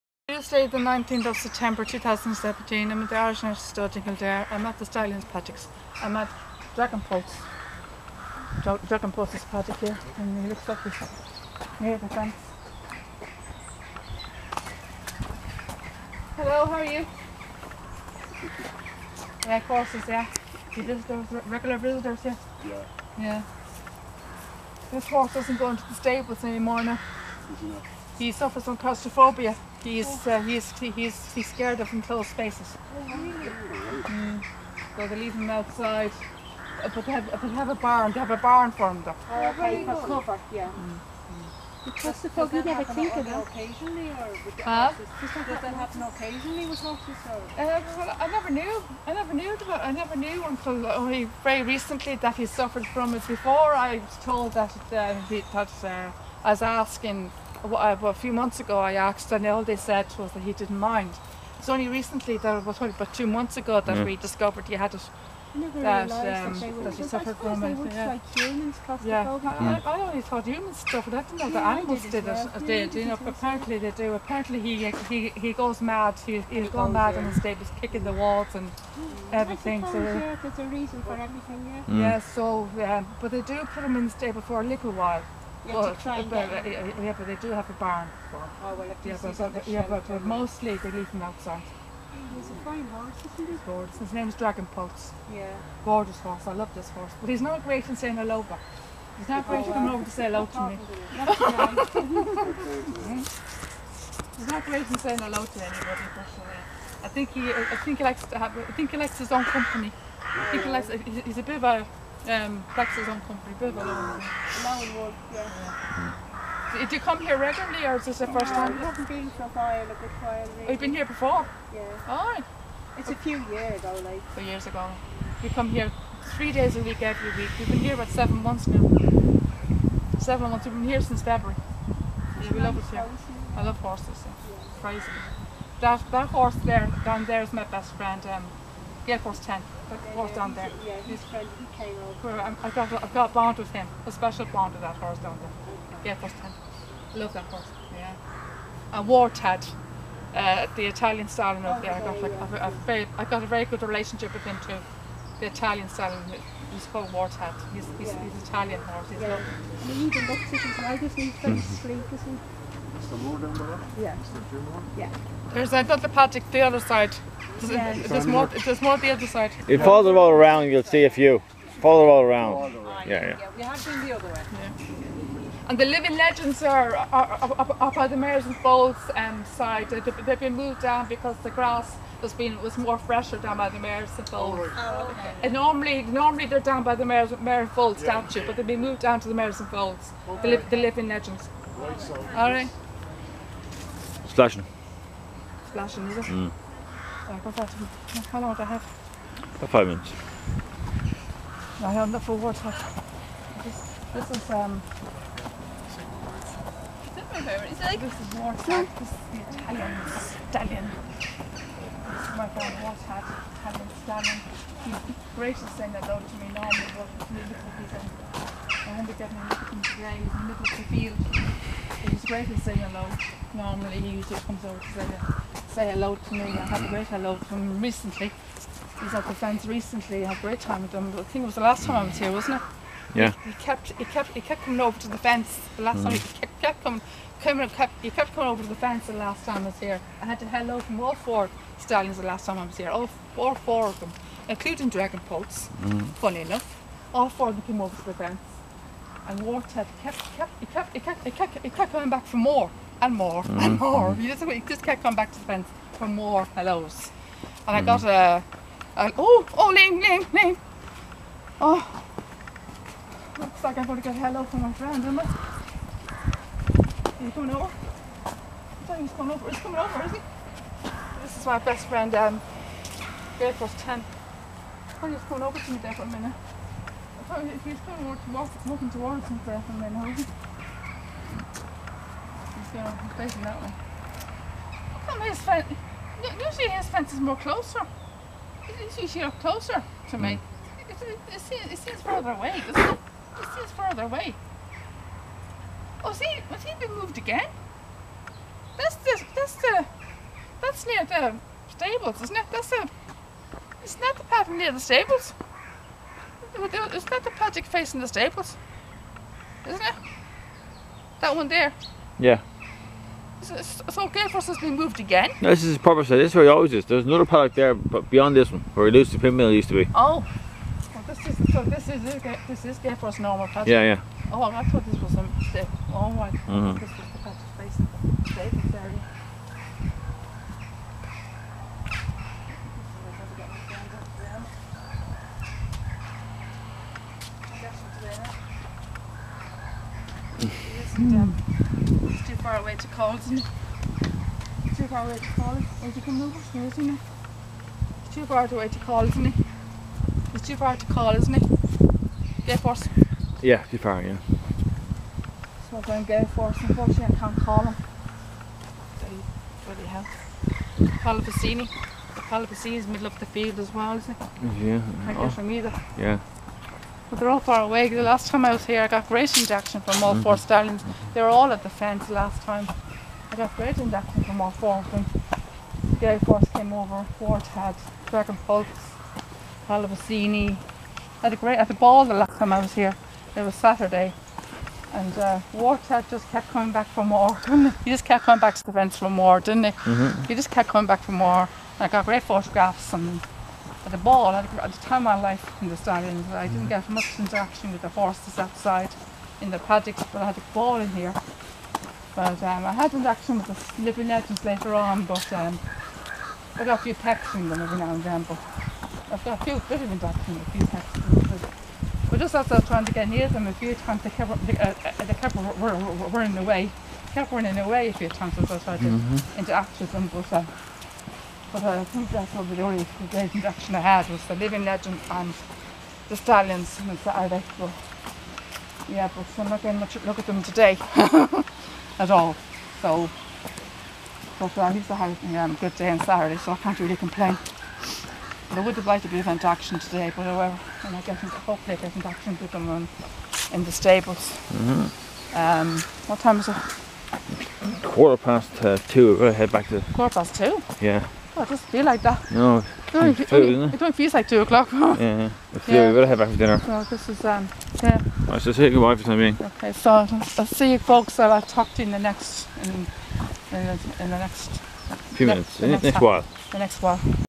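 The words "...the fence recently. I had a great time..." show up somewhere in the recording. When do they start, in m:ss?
3:49.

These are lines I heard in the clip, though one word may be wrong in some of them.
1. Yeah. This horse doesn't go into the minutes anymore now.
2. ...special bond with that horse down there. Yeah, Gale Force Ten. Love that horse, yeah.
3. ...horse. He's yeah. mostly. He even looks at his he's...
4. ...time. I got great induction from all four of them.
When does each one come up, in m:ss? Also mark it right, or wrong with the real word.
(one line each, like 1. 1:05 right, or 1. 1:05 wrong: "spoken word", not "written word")
1. 0:23 wrong: "stables", not "minutes"
2. 2:24 right
3. 2:38 wrong: "lovely", not "mostly"
4. 6:12 right.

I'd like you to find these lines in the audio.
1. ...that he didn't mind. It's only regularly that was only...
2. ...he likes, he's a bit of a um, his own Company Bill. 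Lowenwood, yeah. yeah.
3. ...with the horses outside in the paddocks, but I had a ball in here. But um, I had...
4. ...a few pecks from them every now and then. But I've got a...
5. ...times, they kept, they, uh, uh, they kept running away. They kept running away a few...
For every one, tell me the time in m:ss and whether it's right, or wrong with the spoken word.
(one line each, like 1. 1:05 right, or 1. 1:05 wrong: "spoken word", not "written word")
1. 1:00 wrong: "recently", not "regularly"
2. 1:50 right
3. 6:37 right
4. 6:46 right
5. 6:53 right.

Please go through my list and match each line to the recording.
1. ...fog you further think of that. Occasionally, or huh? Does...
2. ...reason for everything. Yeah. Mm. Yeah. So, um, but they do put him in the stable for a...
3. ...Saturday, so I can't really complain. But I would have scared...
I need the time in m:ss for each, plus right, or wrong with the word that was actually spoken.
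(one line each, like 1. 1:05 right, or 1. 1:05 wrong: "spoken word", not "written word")
1. 0:42 wrong: "never", not "further"
2. 1:20 right
3. 7:15 wrong: "liked", not "scared".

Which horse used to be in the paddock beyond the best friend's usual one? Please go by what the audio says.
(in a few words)
Elusive Pimpernel.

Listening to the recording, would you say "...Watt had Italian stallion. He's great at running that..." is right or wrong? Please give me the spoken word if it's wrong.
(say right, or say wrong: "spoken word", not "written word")
wrong: "saying", not "running".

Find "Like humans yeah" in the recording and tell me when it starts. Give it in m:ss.
1:08.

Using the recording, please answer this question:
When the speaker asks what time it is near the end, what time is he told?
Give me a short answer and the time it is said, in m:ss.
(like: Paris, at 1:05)
Quarter past two, at 7:27.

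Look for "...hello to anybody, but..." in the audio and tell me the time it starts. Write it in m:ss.
1:45.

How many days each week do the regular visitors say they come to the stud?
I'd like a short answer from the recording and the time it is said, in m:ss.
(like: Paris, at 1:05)
3, at 2:05.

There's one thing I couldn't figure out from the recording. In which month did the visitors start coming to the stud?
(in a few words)
February.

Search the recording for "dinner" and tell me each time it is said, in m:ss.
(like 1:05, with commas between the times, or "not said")
7:36.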